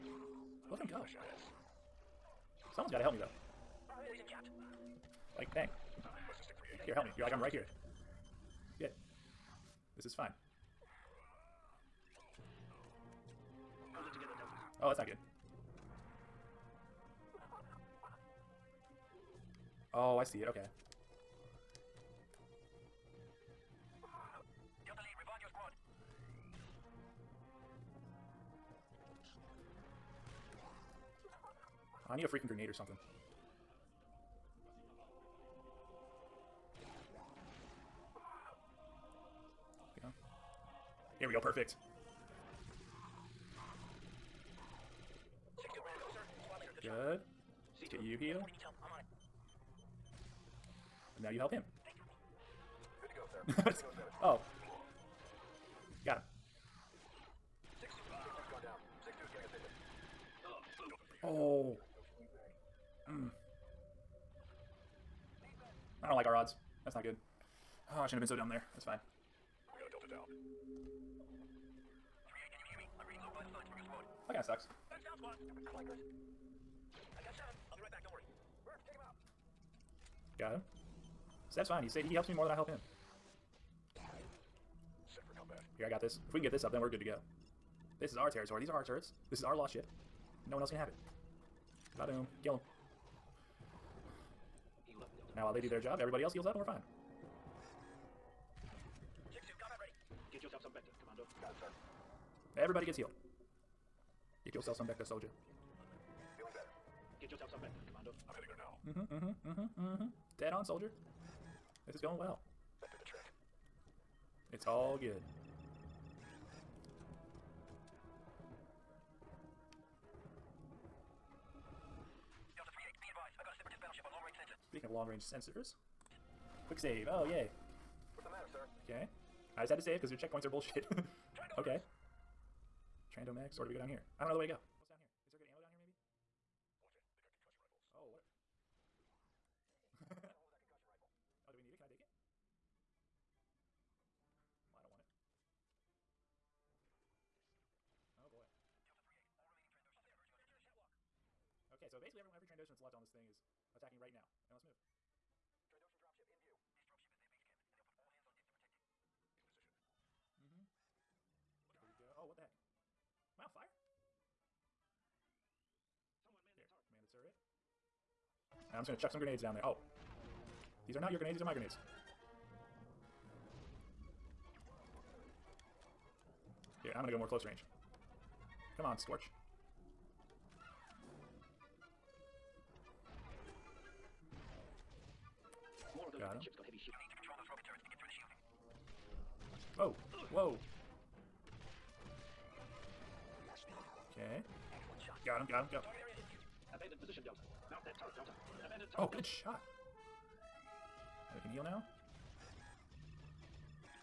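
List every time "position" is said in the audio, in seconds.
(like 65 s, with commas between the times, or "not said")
150 s, 197 s.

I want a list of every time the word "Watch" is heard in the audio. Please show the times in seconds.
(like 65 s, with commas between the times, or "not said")
136 s.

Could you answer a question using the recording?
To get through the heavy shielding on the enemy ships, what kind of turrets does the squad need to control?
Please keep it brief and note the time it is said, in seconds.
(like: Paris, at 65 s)
Rocket turrets, at 187 s.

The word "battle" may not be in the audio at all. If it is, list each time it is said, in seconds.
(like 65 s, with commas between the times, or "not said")
not said.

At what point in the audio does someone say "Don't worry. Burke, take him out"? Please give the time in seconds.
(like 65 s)
78 s.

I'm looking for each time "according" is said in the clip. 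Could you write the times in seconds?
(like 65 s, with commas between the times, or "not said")
not said.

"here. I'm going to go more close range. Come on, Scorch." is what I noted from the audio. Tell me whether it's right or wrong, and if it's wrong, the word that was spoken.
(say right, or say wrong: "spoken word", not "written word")
right.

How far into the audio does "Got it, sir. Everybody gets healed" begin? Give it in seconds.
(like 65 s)
101 s.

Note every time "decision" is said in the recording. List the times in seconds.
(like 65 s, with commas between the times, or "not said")
not said.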